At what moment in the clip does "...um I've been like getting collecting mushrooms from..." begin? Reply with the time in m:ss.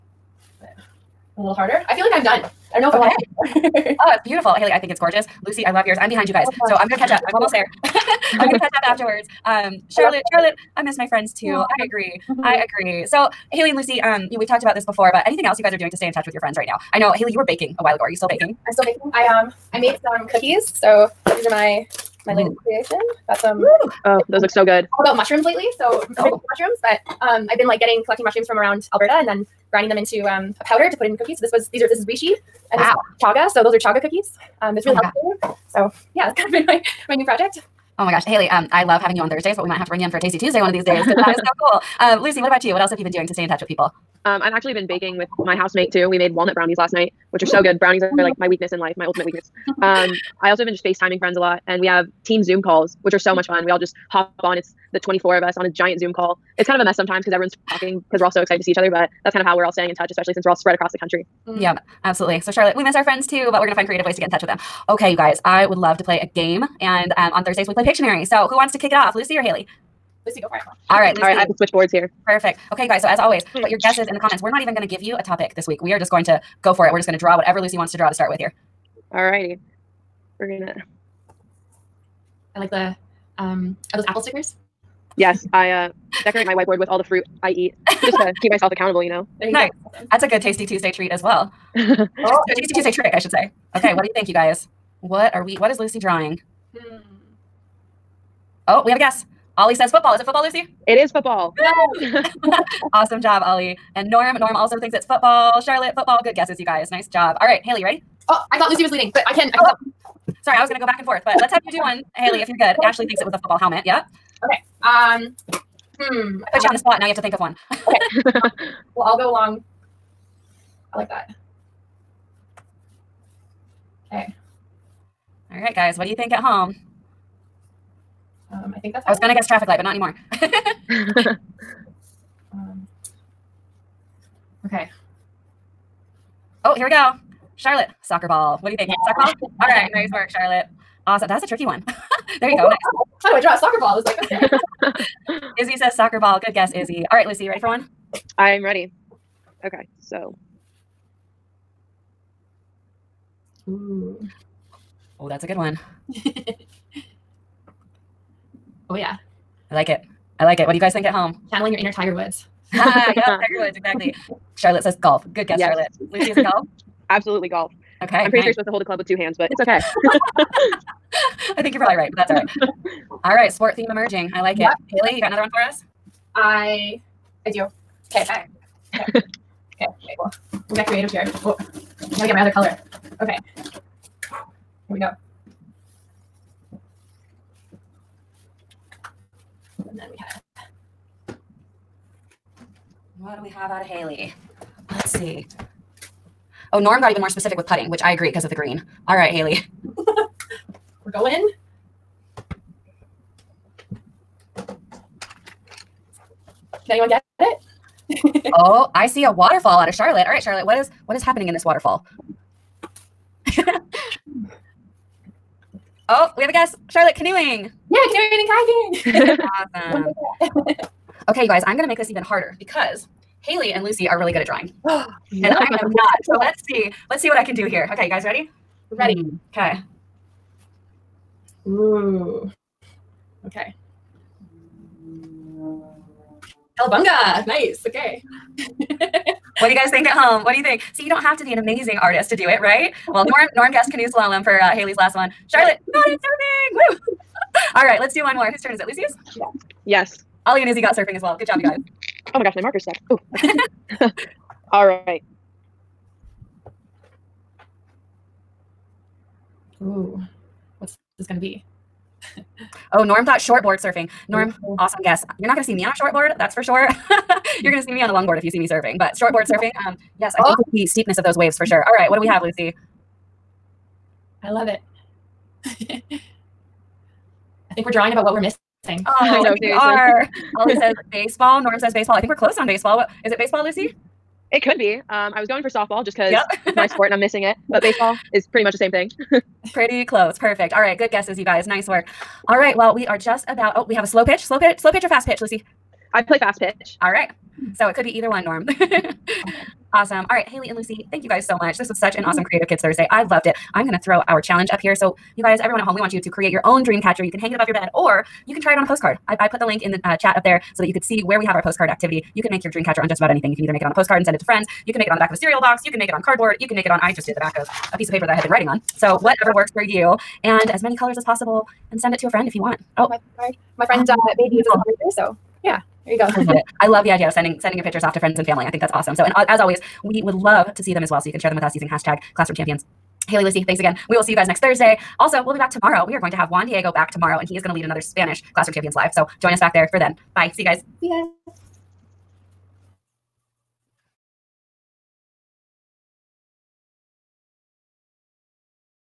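0:27.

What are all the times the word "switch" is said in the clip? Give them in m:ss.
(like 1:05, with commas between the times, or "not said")
1:11.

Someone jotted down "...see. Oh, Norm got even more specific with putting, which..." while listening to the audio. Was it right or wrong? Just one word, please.
right.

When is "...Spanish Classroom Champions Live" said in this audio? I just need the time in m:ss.
5:37.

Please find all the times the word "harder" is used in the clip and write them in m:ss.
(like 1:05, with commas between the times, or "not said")
0:01, 3:42.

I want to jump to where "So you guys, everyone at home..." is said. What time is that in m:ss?
5:04.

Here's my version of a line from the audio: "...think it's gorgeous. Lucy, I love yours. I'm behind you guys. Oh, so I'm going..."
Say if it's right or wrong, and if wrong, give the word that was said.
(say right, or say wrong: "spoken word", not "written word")
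right.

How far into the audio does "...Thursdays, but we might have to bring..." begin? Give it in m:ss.
0:39.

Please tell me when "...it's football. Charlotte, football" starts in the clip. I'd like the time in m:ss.
1:44.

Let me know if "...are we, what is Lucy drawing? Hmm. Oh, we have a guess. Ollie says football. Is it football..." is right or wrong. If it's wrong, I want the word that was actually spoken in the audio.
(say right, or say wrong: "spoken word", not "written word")
right.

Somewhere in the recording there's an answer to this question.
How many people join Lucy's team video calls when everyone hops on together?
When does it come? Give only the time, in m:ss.
0:54.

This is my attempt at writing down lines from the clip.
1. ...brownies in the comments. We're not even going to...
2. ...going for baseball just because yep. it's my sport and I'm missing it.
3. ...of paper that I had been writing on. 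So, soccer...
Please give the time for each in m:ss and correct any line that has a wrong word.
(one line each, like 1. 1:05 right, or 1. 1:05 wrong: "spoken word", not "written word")
1. 1:13 wrong: "guesses", not "brownies"
2. 4:45 wrong: "softball", not "baseball"
3. 5:18 wrong: "whatever", not "soccer".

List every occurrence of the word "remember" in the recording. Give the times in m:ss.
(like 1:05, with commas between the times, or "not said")
not said.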